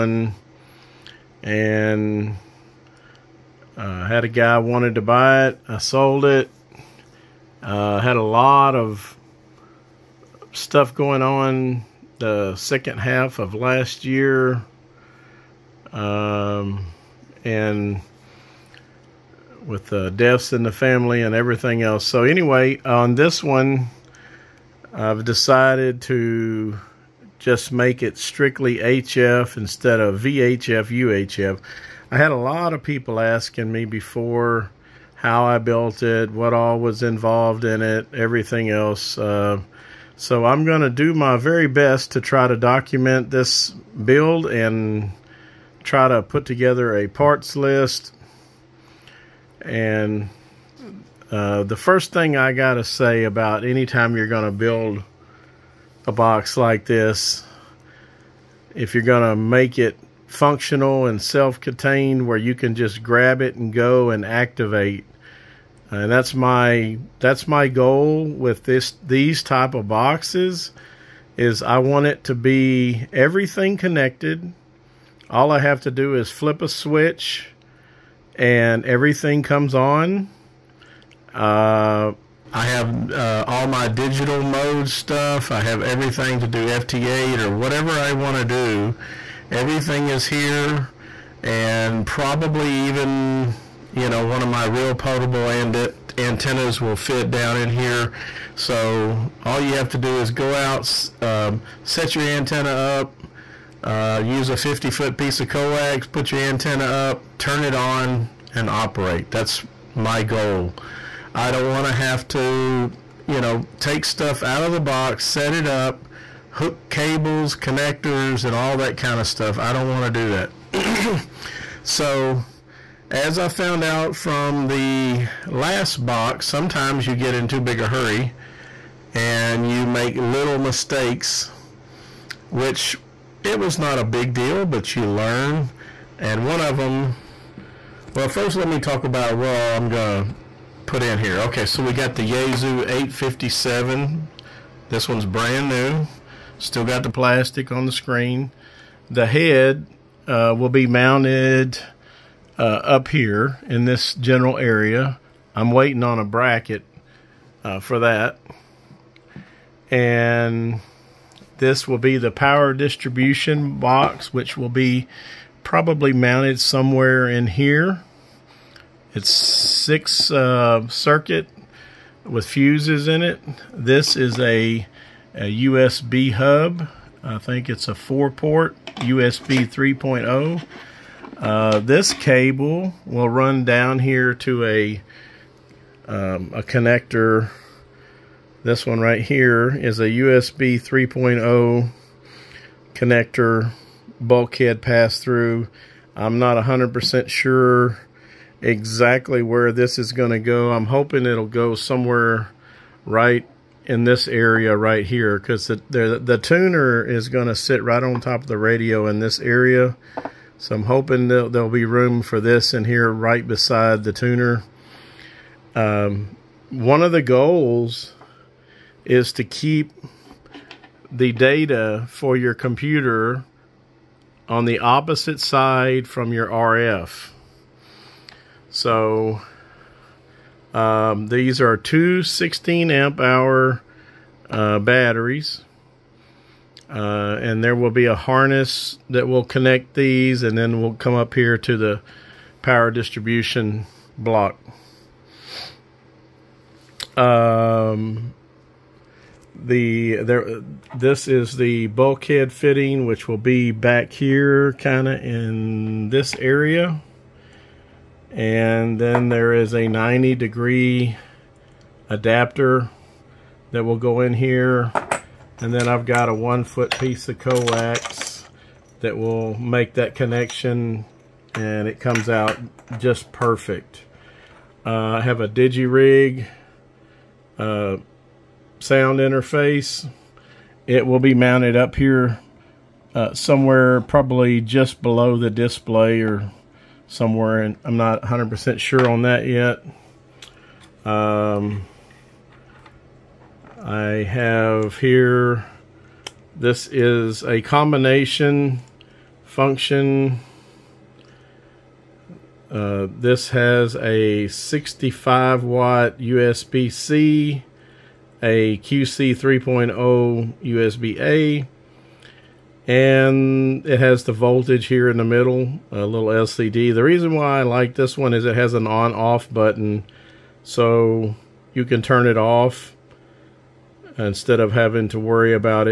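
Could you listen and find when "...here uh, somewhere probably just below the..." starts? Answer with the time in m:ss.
4:41.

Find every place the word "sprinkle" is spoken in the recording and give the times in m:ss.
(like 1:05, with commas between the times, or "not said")
not said.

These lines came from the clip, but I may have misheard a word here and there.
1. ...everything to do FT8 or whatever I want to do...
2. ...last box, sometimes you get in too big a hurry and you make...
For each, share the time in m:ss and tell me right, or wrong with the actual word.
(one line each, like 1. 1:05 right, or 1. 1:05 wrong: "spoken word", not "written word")
1. 1:25 right
2. 2:05 right.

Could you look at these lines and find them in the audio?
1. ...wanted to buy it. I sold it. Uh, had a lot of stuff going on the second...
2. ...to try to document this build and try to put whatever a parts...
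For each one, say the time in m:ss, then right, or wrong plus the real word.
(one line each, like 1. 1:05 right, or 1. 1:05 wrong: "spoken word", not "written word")
1. 0:04 right
2. 0:42 wrong: "together", not "whatever".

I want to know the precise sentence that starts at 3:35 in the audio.
Um, one of the goals is to keep the data for your computer on the opposite side from your RF.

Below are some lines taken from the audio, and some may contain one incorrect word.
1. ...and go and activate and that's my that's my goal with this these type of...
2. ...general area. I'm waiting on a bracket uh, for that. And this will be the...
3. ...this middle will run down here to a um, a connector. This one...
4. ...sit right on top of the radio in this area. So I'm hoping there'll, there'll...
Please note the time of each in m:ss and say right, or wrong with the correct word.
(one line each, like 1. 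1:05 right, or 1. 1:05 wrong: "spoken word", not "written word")
1. 1:03 right
2. 2:34 right
3. 3:01 wrong: "cable", not "middle"
4. 3:27 right.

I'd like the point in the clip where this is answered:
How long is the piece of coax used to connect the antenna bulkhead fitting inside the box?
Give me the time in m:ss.
4:26.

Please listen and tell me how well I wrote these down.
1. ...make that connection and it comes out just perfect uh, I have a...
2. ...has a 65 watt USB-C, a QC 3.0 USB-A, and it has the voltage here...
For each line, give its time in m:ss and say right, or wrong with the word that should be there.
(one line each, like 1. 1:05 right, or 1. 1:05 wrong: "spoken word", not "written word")
1. 4:29 right
2. 5:03 right.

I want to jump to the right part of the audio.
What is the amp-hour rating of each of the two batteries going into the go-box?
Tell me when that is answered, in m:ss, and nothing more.
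3:52.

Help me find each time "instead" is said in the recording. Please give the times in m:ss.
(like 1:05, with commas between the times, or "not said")
0:29, 5:24.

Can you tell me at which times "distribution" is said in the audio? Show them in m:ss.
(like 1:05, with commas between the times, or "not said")
2:42, 4:02.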